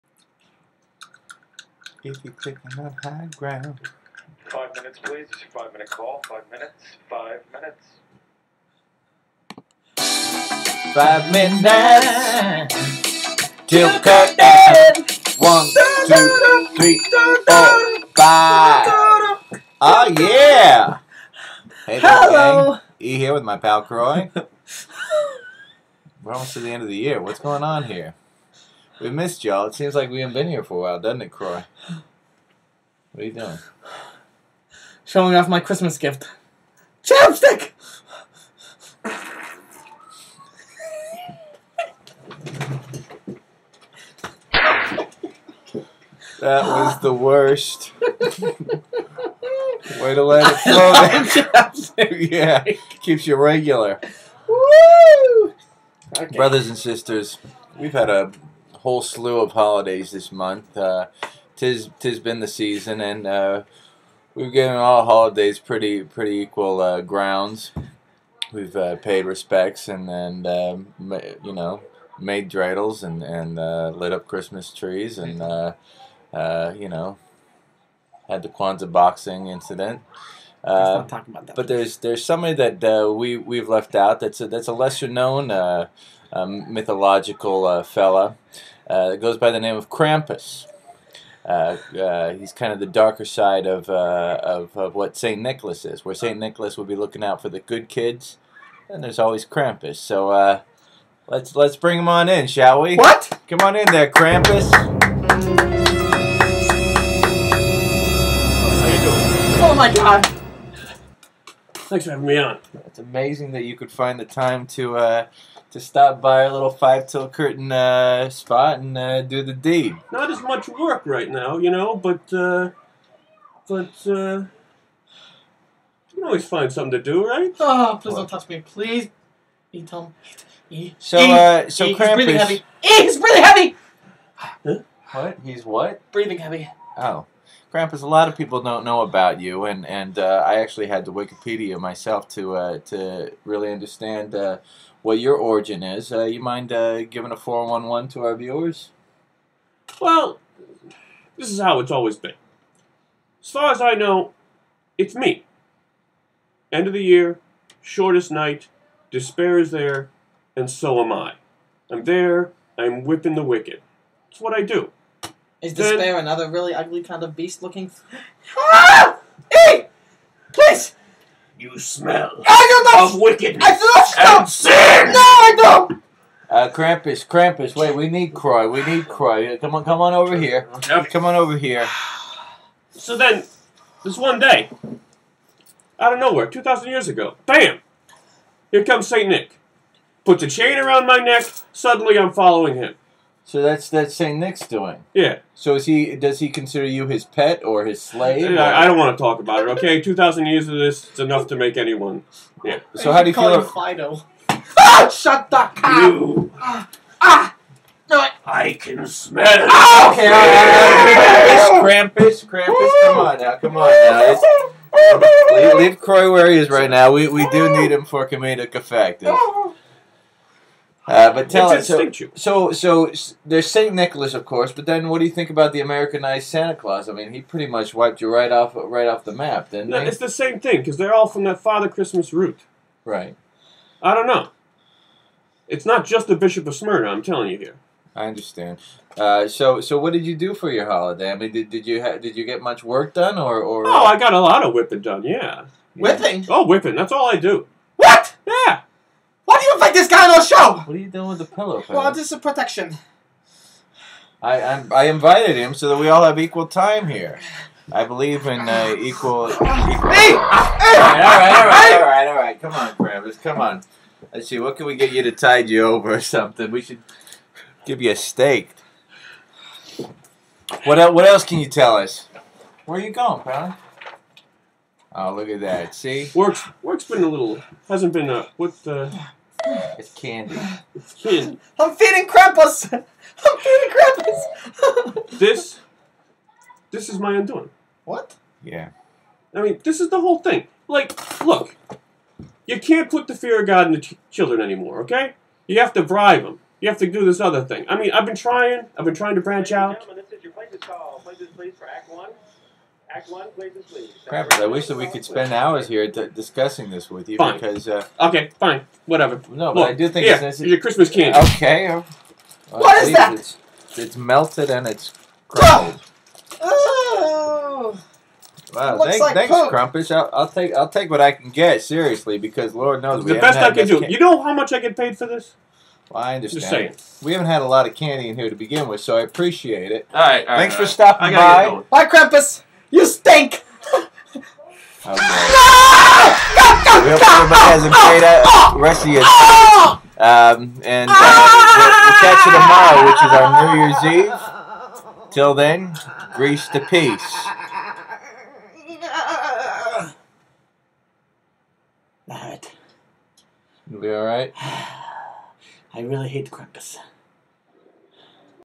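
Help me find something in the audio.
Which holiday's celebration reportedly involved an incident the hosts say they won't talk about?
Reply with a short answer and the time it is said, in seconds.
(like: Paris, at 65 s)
Kwanzaa, at 78 s.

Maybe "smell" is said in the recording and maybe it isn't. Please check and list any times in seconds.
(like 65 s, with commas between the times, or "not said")
171 s, 209 s.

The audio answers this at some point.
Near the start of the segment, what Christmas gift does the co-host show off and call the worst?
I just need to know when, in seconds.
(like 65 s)
37 s.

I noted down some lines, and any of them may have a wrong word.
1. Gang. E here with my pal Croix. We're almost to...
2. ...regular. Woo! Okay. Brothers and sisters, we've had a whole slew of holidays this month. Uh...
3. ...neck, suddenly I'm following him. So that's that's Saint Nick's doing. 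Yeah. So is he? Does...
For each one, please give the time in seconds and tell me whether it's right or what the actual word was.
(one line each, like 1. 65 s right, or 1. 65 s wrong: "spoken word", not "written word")
1. 22 s right
2. 53 s right
3. 191 s right.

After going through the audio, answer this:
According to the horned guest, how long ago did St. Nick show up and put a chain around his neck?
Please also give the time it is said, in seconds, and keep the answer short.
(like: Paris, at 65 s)
2,000 years, at 186 s.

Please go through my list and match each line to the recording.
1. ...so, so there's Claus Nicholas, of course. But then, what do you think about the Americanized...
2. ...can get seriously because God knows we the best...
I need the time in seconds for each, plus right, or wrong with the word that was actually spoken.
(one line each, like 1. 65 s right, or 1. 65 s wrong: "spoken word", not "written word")
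1. 222 s wrong: "Saint", not "Claus"
2. 321 s wrong: "Lord", not "God".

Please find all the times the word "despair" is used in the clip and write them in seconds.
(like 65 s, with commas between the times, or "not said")
159 s, 165 s.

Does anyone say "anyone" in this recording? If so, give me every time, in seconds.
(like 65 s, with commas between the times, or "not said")
201 s.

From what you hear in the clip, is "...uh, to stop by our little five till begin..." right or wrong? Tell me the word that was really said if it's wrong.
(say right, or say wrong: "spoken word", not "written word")
wrong: "curtain", not "begin".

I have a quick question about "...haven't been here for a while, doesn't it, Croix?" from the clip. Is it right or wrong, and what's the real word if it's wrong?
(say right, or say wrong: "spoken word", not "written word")
right.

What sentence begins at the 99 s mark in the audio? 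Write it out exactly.
So let's let's bring him on in, shall we?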